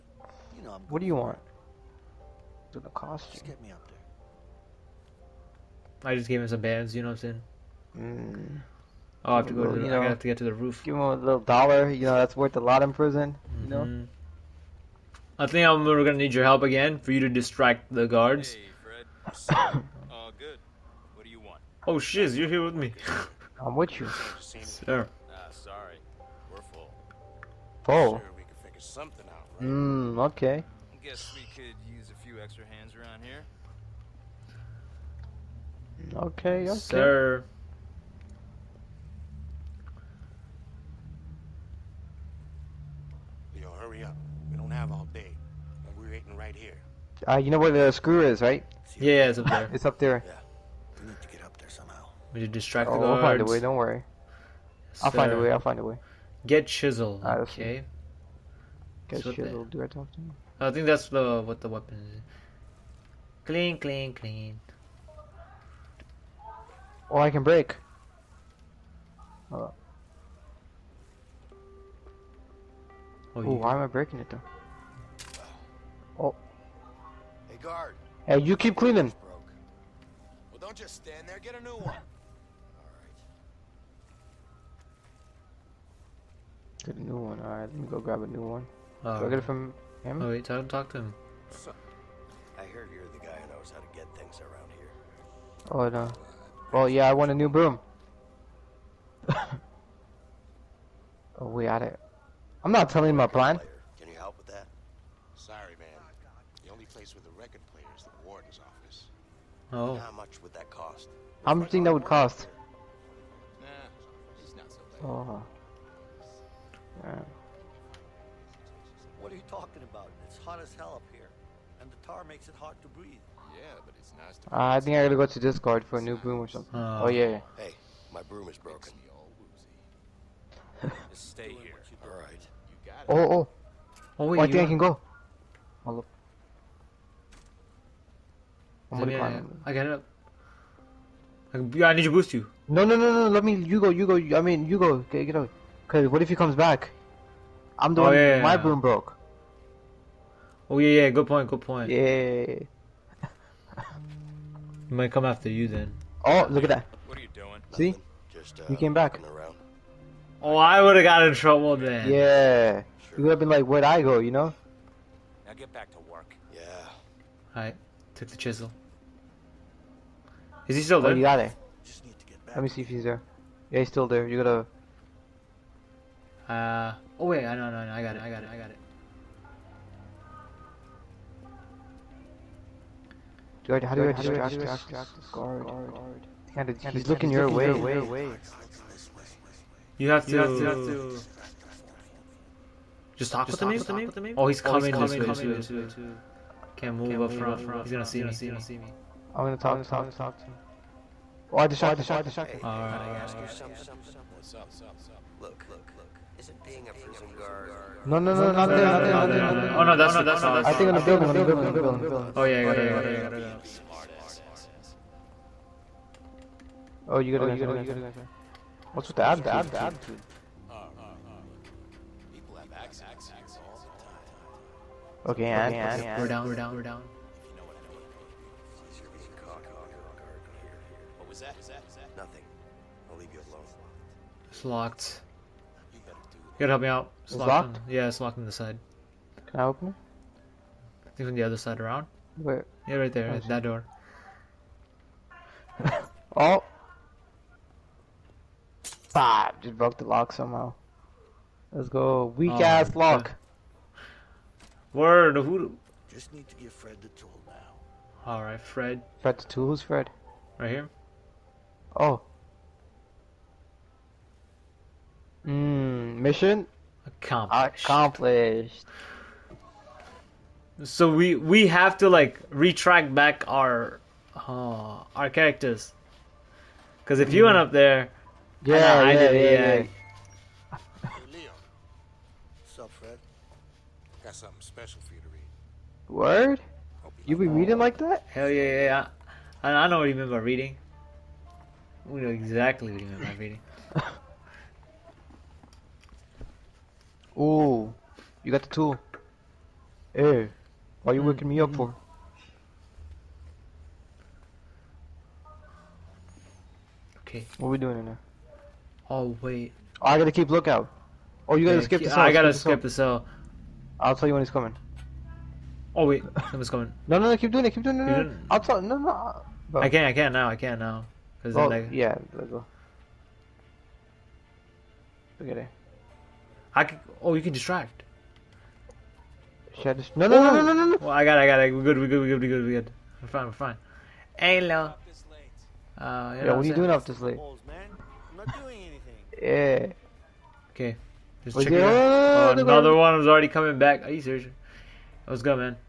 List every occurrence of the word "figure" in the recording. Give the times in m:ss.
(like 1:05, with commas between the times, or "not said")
0:28.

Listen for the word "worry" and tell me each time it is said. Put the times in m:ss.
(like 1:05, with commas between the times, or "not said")
0:53.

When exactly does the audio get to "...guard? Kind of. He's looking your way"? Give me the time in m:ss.
3:05.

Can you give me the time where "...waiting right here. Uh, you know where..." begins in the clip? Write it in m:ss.
0:46.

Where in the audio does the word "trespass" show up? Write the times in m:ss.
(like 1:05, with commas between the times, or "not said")
not said.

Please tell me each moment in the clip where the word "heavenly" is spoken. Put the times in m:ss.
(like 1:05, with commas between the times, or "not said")
not said.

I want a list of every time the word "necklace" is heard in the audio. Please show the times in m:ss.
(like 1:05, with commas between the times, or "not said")
not said.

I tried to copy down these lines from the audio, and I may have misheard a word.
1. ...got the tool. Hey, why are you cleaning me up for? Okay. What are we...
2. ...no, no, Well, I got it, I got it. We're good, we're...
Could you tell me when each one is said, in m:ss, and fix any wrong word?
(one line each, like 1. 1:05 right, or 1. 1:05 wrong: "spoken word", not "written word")
1. 4:58 wrong: "waking", not "cleaning"
2. 5:30 right.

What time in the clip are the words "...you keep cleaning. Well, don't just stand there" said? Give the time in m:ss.
1:18.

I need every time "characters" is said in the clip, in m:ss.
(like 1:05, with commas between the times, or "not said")
4:35.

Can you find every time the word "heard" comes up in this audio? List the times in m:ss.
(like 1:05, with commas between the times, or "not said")
1:32.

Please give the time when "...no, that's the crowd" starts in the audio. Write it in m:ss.
3:29.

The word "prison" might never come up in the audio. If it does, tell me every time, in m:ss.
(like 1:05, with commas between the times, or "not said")
0:12, 3:26.